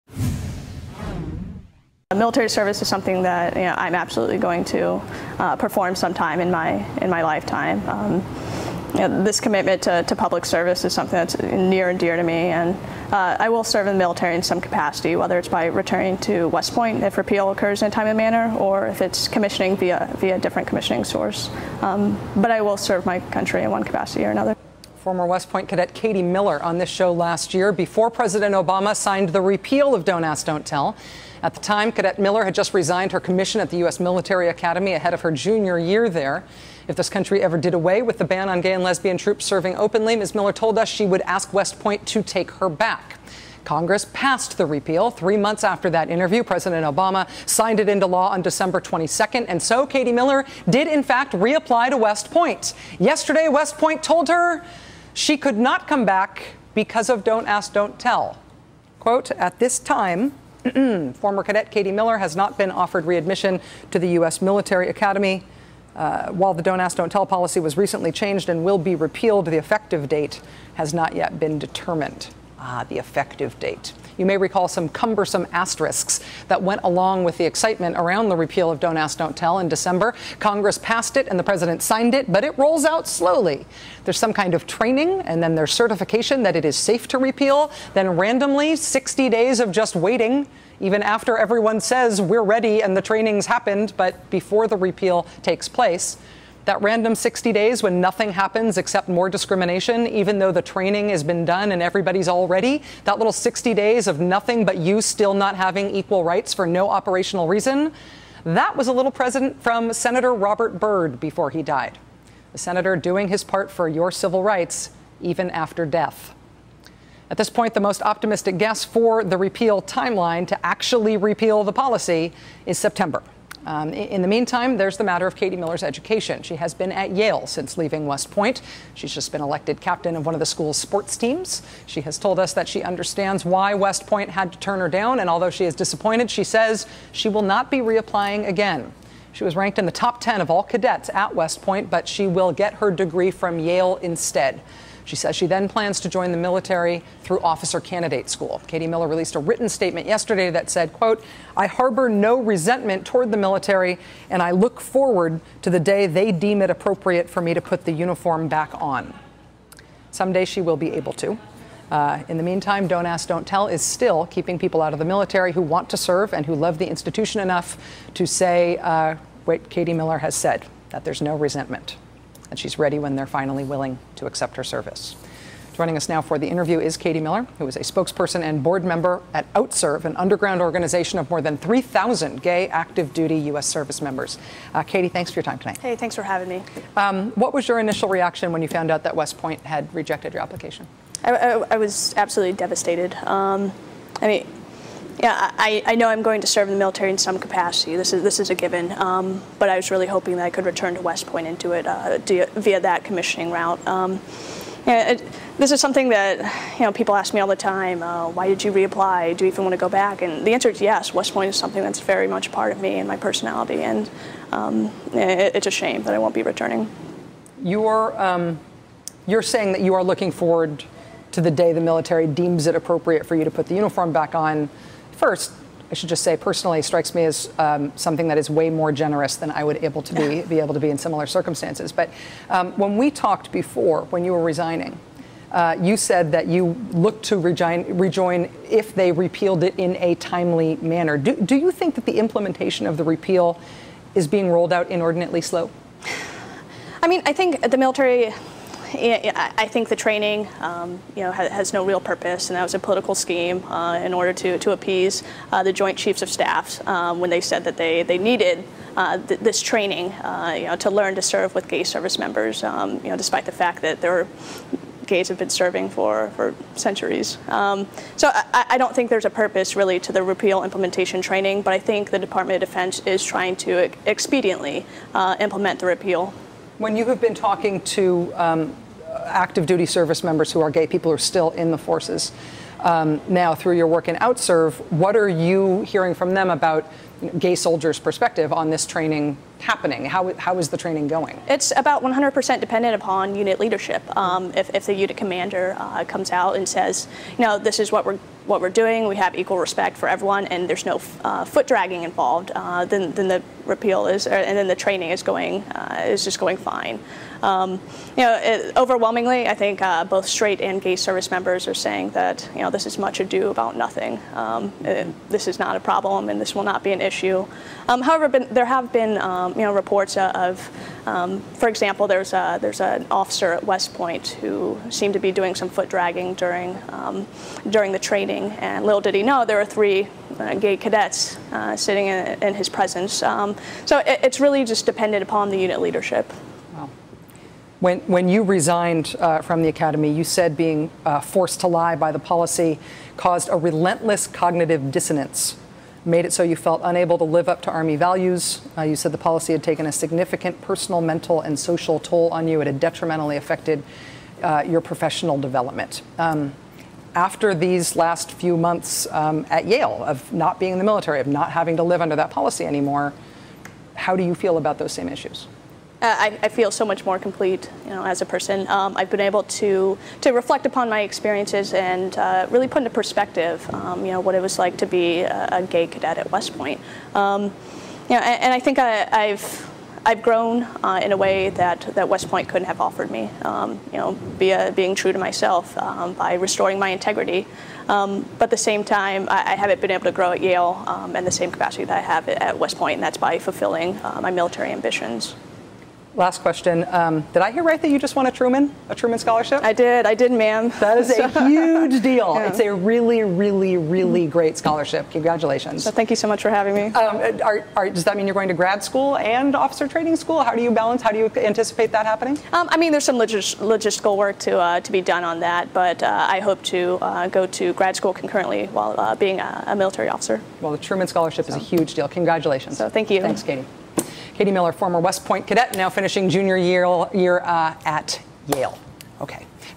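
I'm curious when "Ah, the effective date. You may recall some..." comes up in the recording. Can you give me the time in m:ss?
1:12.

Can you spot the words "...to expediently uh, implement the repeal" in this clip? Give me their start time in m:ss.
4:33.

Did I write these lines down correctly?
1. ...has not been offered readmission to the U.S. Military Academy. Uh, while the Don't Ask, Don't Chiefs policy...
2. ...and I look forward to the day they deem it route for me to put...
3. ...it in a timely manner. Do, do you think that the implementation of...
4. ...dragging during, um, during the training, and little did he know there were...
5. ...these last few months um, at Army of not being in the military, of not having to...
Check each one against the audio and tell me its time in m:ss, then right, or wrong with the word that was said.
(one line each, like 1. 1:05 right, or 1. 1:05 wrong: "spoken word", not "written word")
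1. 1:02 wrong: "Tell", not "Chiefs"
2. 2:34 wrong: "appropriate", not "route"
3. 3:59 right
4. 5:25 right
5. 5:57 wrong: "Yale", not "Army".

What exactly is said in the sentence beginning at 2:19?
She was ranked in the top 10 of all cadets at West Point, but she will get her degree from Yale instead.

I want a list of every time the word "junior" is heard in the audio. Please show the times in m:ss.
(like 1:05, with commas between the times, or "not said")
0:35, 7:06.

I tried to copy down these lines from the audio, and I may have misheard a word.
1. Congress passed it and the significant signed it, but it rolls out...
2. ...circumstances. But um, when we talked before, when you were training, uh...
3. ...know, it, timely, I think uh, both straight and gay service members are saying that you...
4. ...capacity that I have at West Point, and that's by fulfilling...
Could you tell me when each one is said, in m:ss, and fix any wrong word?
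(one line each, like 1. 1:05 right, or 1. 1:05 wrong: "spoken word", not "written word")
1. 1:20 wrong: "president", not "significant"
2. 3:51 wrong: "resigning", not "training"
3. 5:08 wrong: "overwhelmingly", not "timely"
4. 6:31 right.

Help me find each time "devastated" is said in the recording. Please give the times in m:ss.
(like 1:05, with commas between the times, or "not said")
3:12.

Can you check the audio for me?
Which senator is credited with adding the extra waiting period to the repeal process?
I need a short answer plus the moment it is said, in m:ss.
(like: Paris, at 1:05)
Robert Byrd, at 1:50.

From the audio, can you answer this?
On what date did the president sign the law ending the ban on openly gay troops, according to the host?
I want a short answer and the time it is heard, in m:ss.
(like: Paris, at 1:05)
December 22nd, at 0:48.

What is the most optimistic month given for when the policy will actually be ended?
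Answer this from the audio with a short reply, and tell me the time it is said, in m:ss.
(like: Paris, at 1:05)
September, at 2:02.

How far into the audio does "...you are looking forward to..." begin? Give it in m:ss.
3:39.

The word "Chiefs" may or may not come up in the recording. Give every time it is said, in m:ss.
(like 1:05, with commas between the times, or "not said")
4:15.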